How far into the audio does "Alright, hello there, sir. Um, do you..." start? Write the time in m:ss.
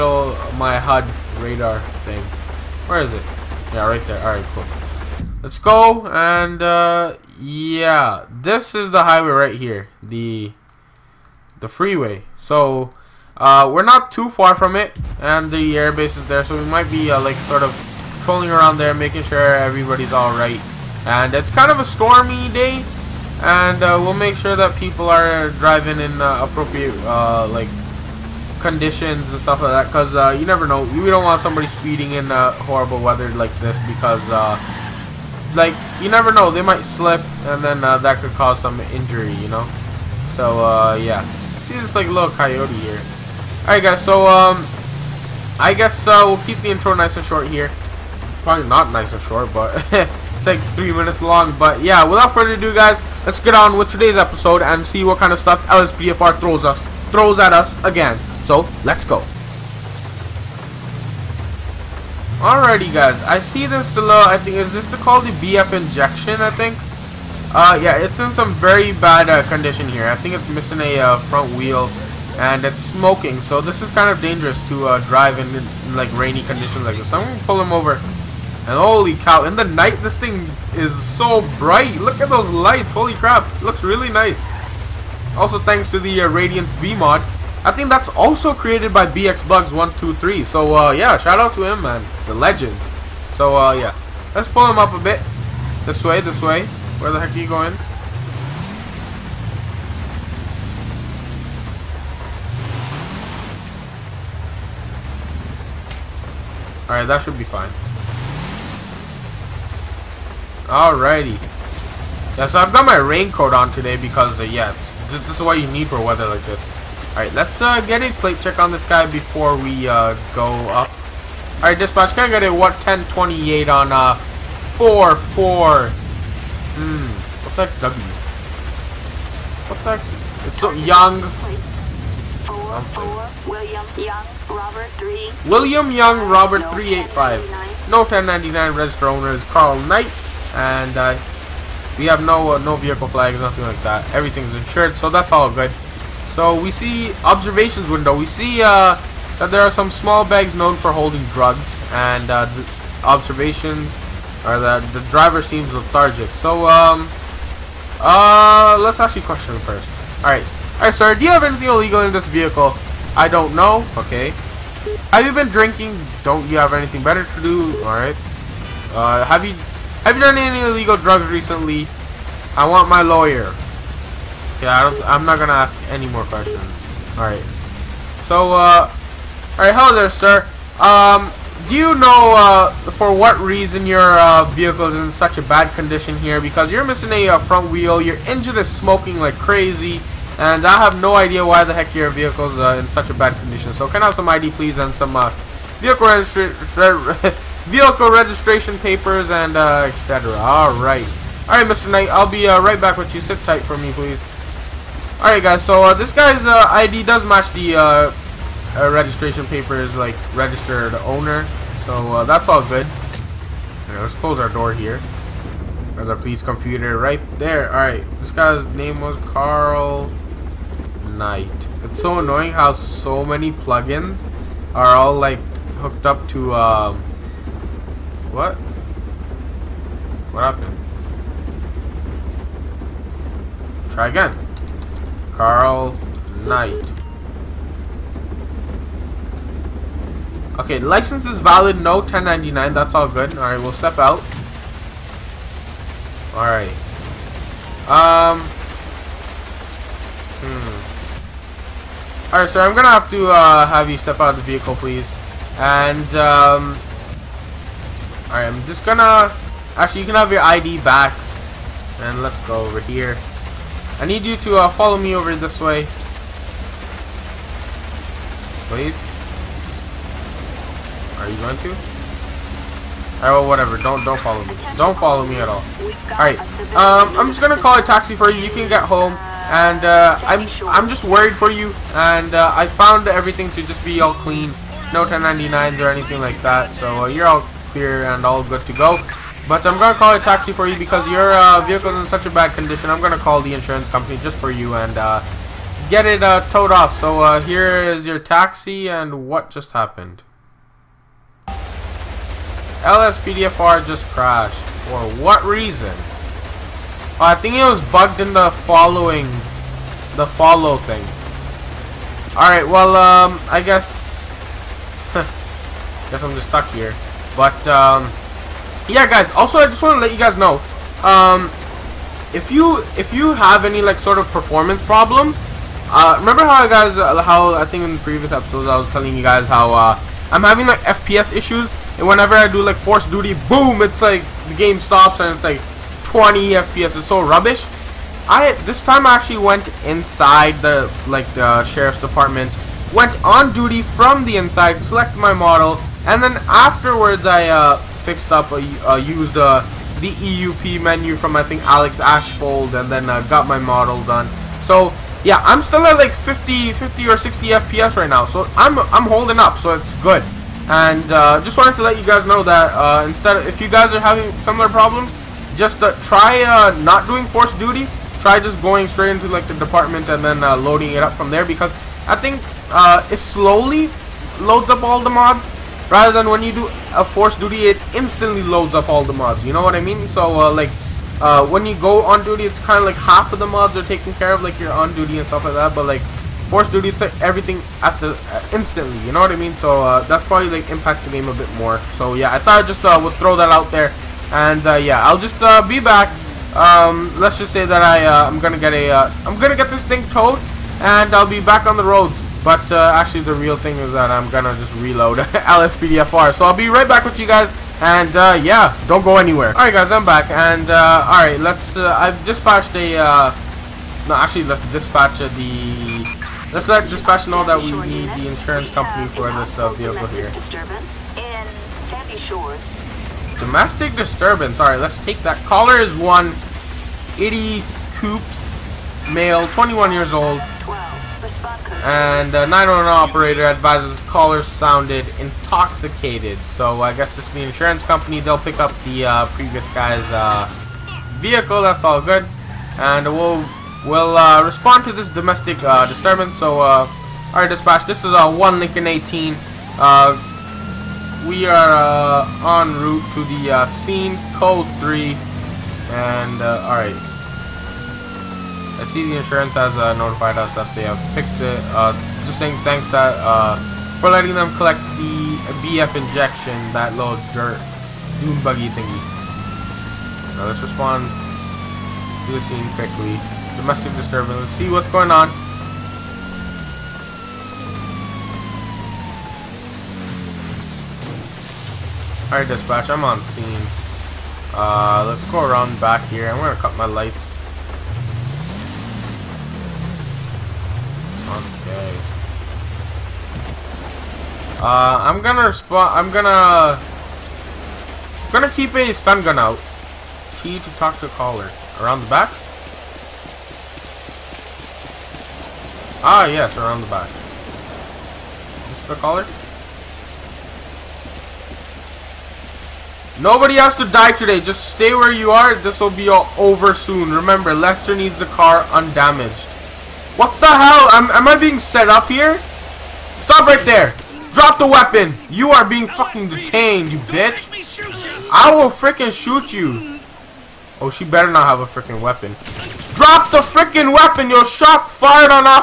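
2:59.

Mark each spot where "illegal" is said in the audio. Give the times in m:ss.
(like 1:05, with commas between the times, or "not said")
2:41, 2:50.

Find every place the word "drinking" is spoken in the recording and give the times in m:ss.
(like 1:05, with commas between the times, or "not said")
2:45.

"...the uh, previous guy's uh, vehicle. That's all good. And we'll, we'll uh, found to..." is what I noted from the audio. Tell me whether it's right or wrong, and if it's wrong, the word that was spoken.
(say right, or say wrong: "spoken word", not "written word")
wrong: "respond", not "found".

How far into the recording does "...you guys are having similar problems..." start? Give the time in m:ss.
6:03.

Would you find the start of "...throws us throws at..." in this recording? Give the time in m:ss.
0:56.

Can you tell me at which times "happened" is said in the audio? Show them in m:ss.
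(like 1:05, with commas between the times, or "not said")
3:50, 4:59.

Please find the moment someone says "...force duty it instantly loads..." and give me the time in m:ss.
6:17.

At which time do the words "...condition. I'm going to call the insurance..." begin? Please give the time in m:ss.
4:52.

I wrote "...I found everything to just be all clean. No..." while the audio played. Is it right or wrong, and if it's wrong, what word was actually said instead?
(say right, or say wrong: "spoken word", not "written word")
right.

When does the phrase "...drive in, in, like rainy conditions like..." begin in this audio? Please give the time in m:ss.
1:15.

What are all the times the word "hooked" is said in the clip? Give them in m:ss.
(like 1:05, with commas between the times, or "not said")
3:45.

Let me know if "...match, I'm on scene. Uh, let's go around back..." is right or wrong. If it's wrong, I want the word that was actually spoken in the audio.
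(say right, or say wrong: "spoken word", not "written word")
wrong: "dispatch", not "match".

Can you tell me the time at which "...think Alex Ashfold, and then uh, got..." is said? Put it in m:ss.
5:51.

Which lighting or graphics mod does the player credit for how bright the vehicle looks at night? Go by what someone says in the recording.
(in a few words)
Radiance V.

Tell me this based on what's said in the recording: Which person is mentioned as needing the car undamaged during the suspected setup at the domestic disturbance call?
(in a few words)
Lester.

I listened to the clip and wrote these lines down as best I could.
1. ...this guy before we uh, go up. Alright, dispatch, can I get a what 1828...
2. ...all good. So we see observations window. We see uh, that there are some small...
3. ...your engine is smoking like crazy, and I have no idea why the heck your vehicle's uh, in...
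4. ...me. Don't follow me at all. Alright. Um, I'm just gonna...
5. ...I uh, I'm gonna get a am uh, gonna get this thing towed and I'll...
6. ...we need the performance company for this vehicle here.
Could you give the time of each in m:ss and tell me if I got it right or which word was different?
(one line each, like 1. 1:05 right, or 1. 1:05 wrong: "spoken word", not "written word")
1. 1:58 wrong: "1028", not "1828"
2. 2:25 right
3. 3:07 right
4. 4:34 right
5. 6:37 right
6. 6:57 wrong: "insurance", not "performance".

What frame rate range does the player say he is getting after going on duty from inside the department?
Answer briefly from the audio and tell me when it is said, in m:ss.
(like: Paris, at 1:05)
50 or 60 FPS, at 5:56.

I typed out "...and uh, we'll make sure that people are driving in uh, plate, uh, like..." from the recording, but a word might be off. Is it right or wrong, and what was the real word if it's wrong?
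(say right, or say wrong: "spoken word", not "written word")
wrong: "appropriate", not "plate".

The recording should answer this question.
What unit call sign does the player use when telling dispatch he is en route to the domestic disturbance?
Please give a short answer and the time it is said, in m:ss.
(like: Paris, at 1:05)
1 Lincoln 18, at 7:28.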